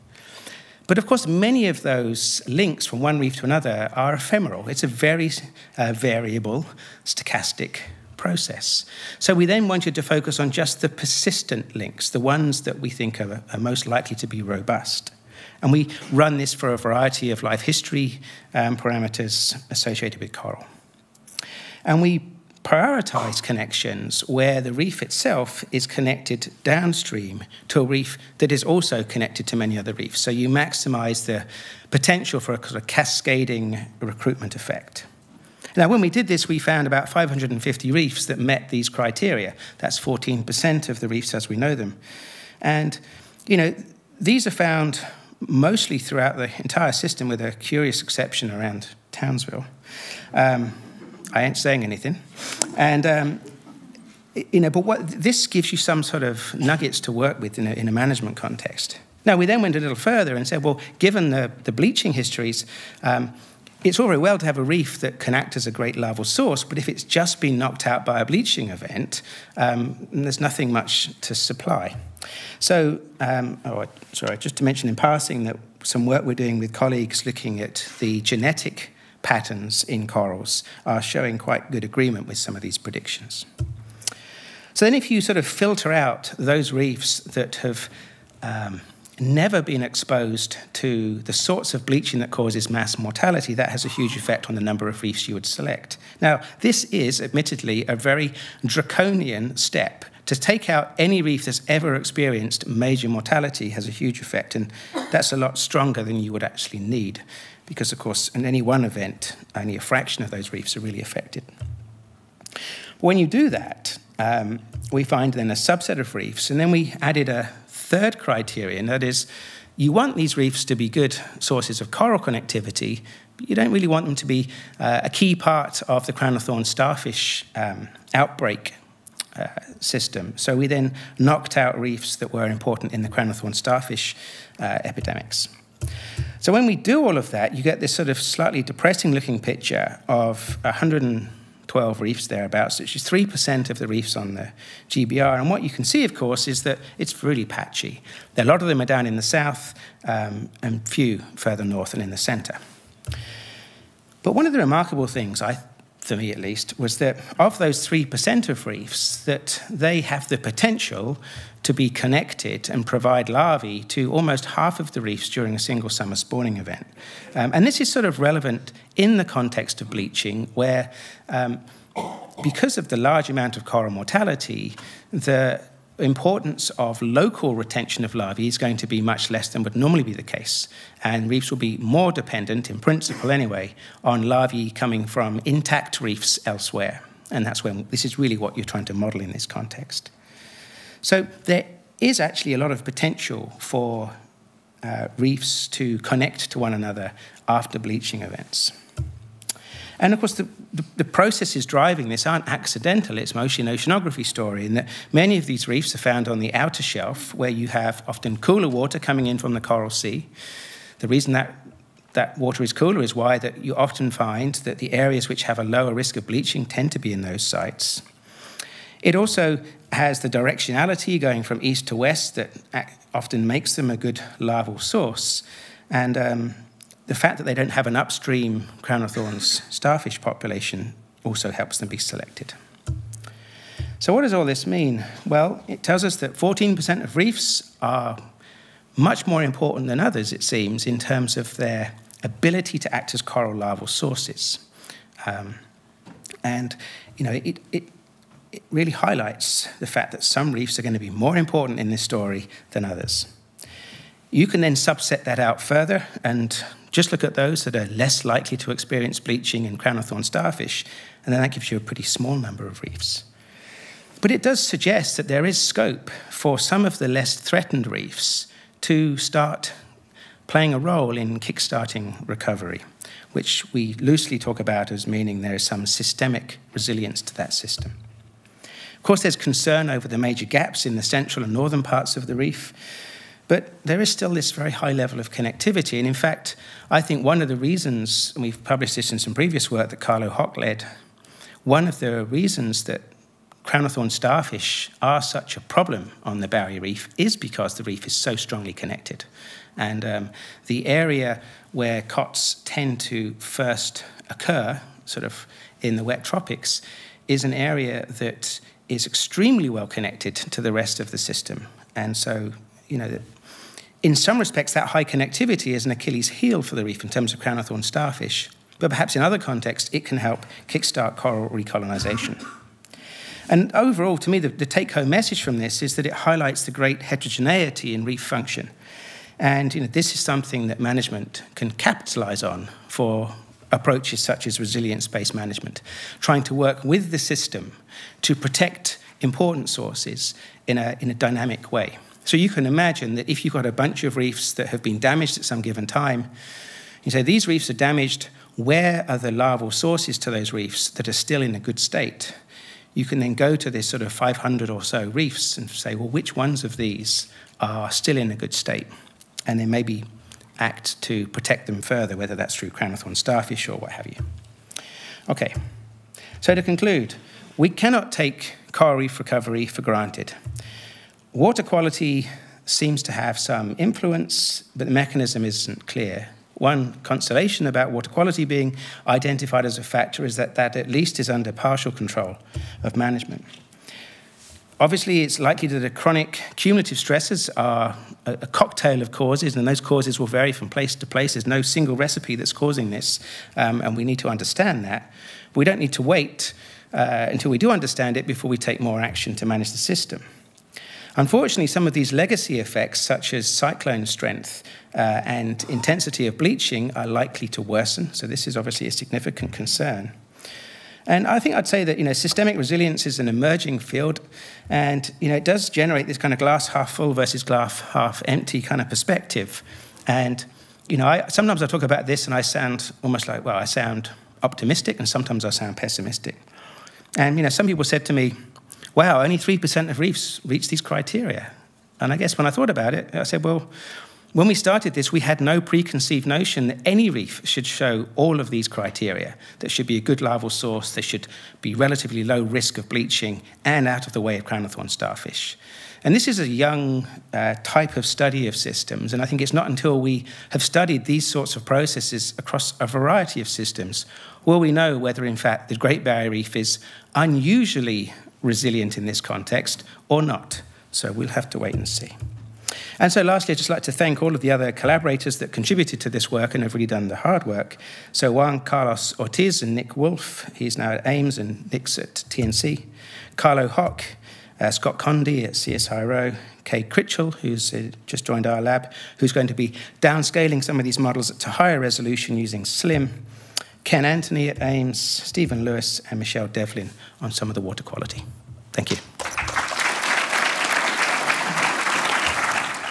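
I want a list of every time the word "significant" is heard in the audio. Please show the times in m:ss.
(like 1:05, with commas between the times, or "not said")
6:48.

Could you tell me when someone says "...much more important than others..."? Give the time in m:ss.
3:58.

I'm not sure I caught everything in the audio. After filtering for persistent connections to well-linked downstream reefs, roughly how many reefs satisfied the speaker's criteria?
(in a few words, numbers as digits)
550.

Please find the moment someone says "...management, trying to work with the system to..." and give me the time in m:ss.
5:35.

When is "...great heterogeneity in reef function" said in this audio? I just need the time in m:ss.
5:26.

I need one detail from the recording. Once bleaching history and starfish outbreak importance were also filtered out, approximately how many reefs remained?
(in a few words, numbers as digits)
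112.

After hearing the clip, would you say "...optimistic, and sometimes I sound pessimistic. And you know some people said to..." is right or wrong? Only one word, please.
right.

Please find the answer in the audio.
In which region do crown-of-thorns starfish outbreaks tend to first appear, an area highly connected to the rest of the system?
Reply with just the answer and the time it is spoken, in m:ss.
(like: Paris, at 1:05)
Wet tropics, at 5:06.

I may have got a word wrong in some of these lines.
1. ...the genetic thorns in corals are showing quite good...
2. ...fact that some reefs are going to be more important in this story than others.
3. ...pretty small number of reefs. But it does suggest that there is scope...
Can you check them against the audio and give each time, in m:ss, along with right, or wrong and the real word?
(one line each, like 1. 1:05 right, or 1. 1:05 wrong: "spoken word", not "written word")
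1. 1:17 wrong: "patterns", not "thorns"
2. 4:09 right
3. 4:21 right.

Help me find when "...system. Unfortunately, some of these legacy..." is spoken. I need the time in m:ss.
6:39.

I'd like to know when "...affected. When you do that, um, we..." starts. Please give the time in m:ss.
1:51.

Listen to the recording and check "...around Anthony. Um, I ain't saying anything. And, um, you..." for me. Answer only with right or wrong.
wrong.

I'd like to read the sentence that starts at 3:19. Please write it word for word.
And of course, the, the, the, processes driving this aren't accidental.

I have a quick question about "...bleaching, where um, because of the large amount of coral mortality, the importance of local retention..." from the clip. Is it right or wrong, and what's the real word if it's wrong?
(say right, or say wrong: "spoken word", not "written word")
right.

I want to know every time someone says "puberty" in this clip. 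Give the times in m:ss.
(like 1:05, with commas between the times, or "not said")
not said.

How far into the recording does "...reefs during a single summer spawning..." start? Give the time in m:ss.
2:44.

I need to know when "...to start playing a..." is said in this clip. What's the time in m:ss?
4:28.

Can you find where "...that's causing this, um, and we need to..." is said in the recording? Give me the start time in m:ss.
6:32.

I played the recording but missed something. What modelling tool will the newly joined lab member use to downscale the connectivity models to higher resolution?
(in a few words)
SLIM.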